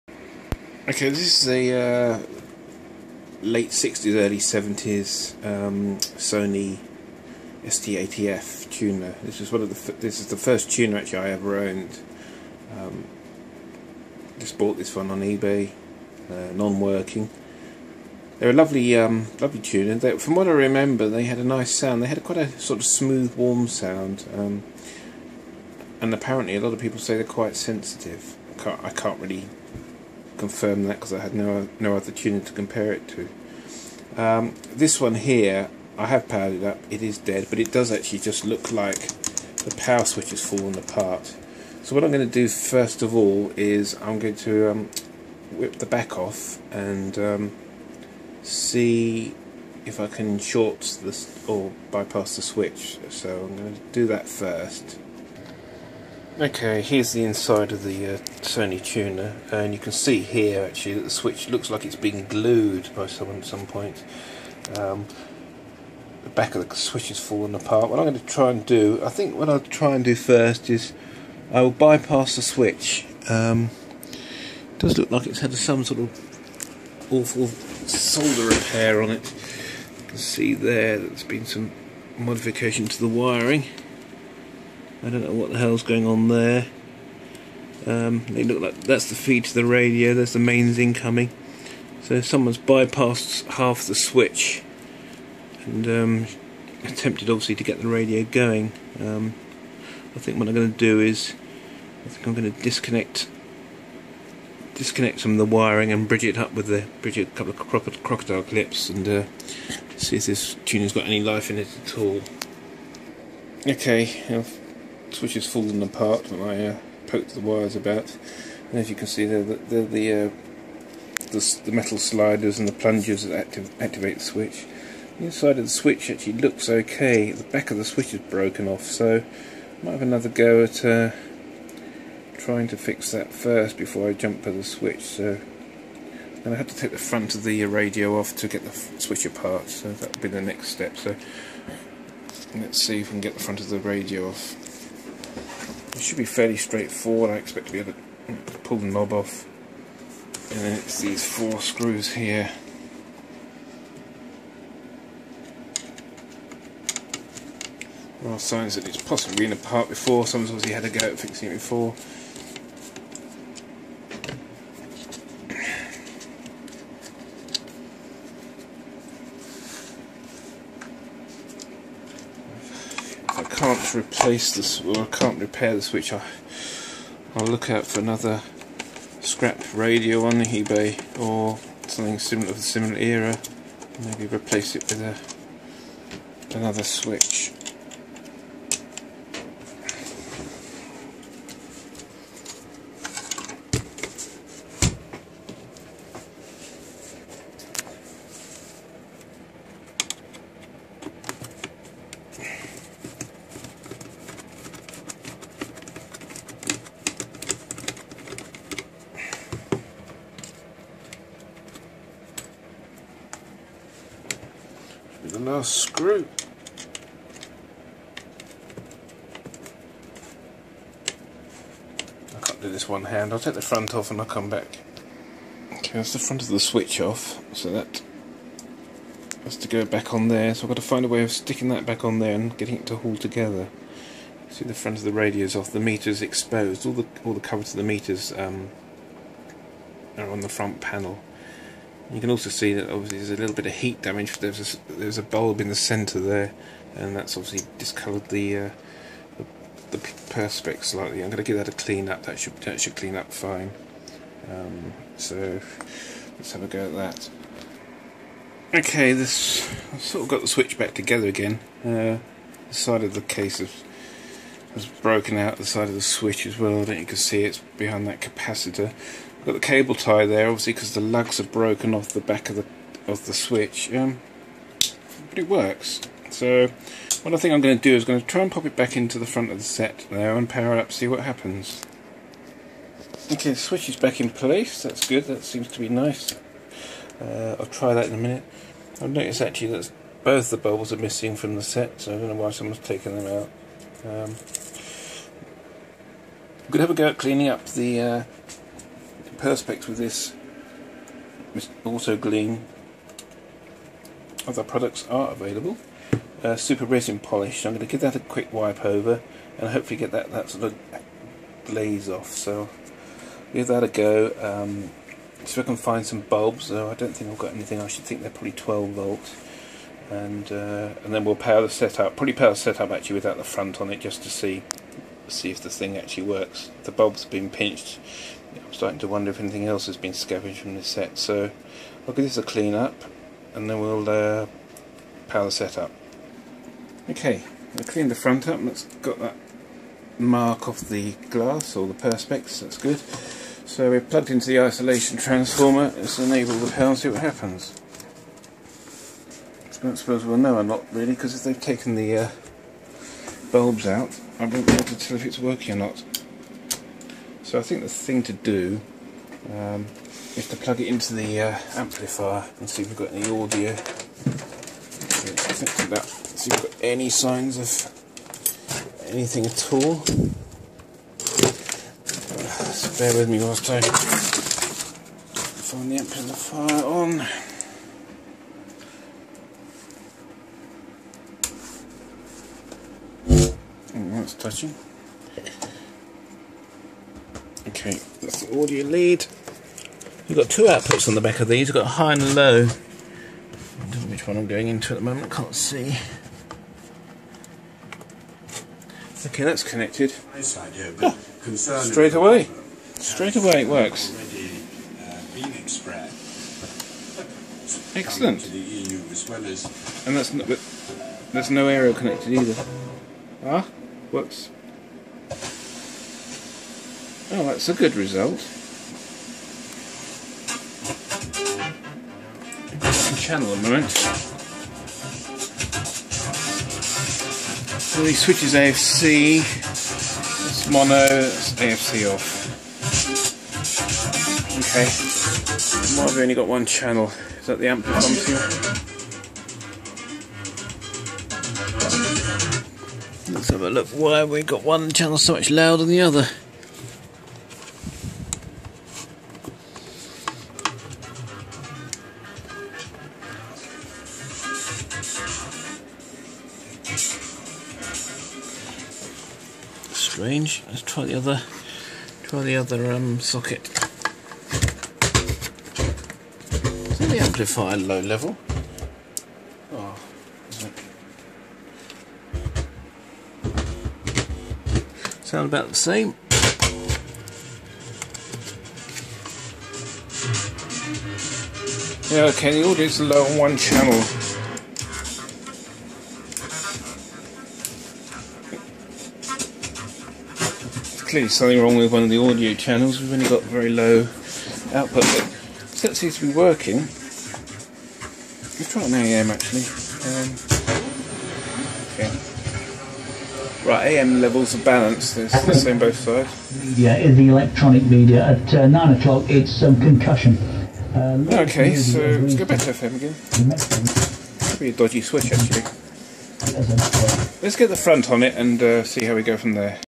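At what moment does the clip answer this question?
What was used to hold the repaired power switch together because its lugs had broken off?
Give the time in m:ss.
4:29.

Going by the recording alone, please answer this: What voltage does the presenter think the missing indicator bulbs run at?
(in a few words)
12 volts.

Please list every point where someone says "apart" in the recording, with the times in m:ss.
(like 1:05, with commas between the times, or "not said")
0:40, 1:07, 1:55, 2:19, 2:39.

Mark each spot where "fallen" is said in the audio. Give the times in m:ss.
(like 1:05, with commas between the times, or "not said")
0:40, 1:07, 1:55.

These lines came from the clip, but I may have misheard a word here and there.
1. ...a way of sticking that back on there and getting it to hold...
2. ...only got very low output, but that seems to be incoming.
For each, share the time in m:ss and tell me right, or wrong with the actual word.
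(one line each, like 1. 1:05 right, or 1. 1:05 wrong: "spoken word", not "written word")
1. 3:51 right
2. 8:13 wrong: "working", not "incoming".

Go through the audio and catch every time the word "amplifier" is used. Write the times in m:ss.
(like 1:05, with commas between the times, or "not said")
6:01, 6:15, 7:47.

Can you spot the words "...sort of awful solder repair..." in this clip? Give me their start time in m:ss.
1:15.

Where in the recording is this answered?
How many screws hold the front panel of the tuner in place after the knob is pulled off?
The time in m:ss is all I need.
2:31.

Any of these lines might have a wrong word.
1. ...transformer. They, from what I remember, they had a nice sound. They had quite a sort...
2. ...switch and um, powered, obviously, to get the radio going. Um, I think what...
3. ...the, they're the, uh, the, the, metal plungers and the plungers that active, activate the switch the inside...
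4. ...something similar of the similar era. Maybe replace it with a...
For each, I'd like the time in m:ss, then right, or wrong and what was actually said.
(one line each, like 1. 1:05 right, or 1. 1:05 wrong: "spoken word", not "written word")
1. 0:19 wrong: "tuner", not "transformer"
2. 1:33 wrong: "attempted", not "powered"
3. 1:59 wrong: "sliders", not "plungers"
4. 3:01 right.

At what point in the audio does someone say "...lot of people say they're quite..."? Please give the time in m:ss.
0:26.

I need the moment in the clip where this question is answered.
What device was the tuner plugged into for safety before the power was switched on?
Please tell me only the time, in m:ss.
5:44.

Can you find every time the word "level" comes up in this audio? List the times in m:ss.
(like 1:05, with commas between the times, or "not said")
7:48, 8:24.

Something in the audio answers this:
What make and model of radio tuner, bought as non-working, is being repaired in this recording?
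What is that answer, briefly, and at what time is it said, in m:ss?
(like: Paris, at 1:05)
Sony ST-80F, at 0:05.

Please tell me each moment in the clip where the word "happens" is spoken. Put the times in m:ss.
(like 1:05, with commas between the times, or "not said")
4:41, 5:47.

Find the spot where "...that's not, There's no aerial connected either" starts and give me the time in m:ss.
6:50.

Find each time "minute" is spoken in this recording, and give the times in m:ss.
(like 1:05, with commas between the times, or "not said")
4:48.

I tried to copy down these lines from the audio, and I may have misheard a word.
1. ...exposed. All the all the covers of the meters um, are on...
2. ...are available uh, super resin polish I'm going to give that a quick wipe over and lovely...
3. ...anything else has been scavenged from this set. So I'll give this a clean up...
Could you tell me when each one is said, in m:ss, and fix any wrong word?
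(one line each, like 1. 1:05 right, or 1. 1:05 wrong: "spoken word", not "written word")
1. 3:56 right
2. 5:05 wrong: "hopefully", not "lovely"
3. 5:29 right.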